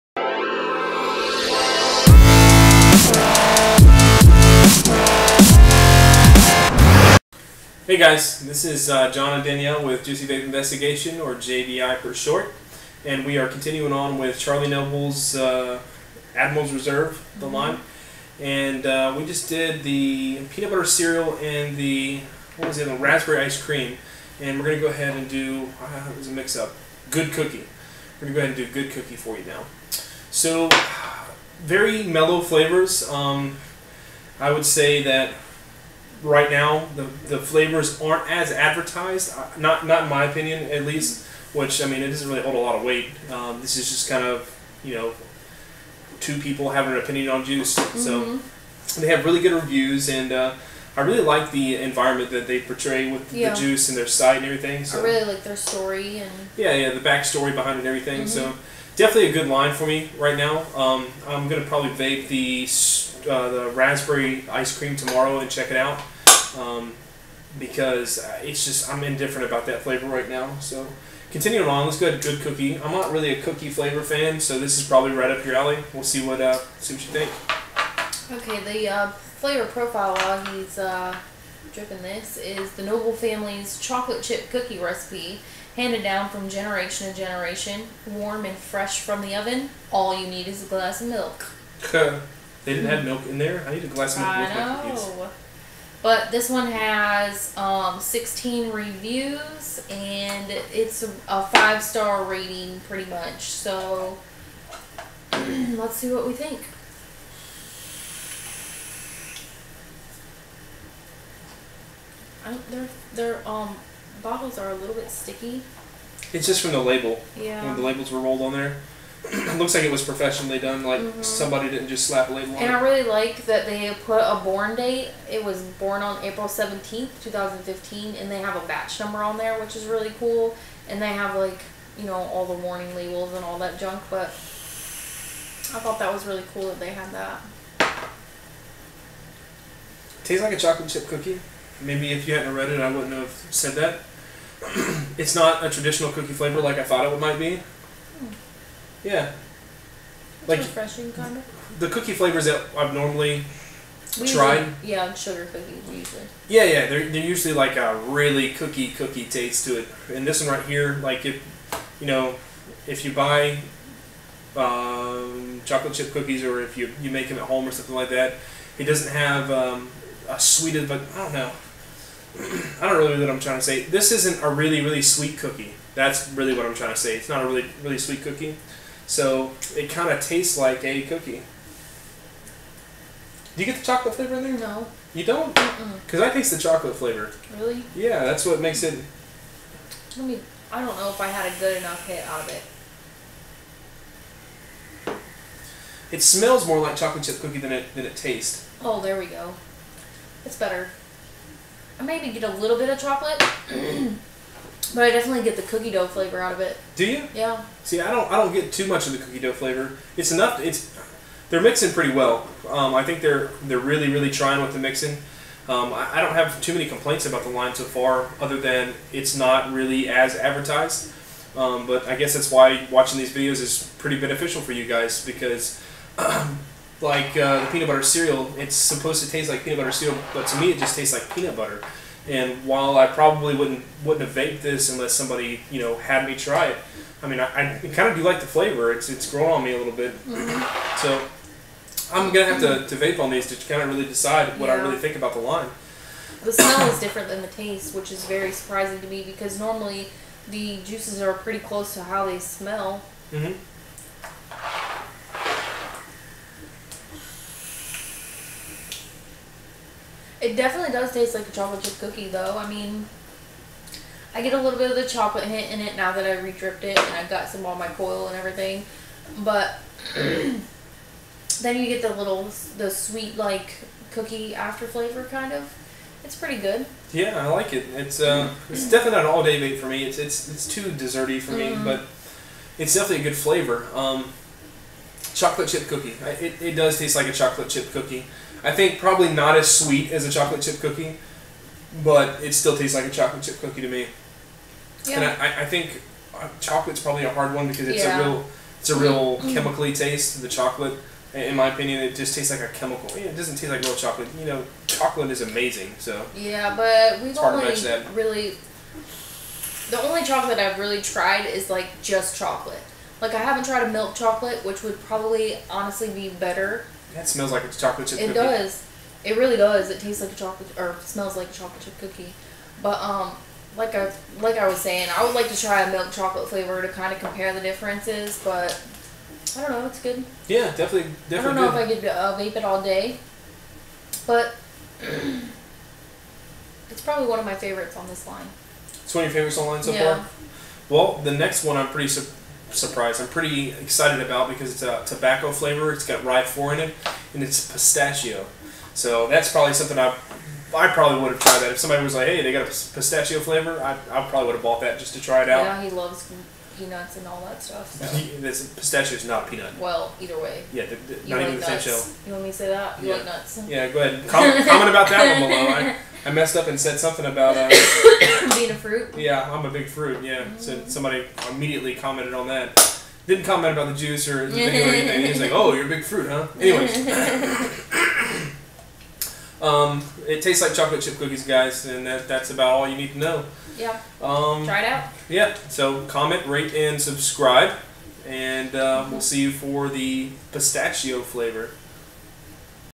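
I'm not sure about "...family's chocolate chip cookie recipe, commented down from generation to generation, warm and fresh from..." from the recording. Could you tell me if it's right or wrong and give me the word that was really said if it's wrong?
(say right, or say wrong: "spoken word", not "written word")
wrong: "handed", not "commented".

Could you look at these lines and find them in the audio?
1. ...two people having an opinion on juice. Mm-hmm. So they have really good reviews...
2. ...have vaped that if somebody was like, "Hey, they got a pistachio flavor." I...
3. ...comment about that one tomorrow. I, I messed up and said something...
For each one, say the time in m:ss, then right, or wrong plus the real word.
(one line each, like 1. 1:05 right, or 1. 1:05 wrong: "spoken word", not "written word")
1. 0:46 right
2. 5:51 wrong: "tried", not "vaped"
3. 6:04 wrong: "below", not "tomorrow".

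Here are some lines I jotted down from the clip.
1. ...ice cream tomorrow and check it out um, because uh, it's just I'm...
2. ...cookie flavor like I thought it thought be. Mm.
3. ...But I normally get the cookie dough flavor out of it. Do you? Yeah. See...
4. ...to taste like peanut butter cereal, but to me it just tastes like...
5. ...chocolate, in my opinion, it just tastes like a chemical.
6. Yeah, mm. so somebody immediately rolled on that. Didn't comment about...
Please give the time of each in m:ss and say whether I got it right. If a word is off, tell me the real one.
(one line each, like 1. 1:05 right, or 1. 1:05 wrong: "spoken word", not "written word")
1. 1:04 right
2. 2:26 wrong: "might", not "thought"
3. 3:24 wrong: "definitely", not "normally"
4. 3:49 right
5. 5:00 right
6. 6:10 wrong: "commented", not "rolled".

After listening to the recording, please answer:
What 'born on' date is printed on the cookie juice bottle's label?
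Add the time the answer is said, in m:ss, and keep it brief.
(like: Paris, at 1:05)
April 17, 2015, at 2:06.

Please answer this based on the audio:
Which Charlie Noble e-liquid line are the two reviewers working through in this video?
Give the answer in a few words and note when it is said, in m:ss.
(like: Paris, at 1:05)
Admiral's Reserve, at 0:16.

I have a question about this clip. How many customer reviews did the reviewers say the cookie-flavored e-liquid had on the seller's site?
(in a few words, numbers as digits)
16.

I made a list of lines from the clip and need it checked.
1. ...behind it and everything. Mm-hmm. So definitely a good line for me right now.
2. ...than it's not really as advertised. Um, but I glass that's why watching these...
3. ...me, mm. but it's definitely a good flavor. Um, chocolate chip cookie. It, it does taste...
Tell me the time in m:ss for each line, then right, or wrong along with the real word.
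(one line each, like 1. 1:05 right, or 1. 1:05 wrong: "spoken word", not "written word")
1. 0:57 right
2. 3:38 wrong: "guess", not "glass"
3. 4:41 right.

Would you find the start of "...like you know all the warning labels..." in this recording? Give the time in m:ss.
2:11.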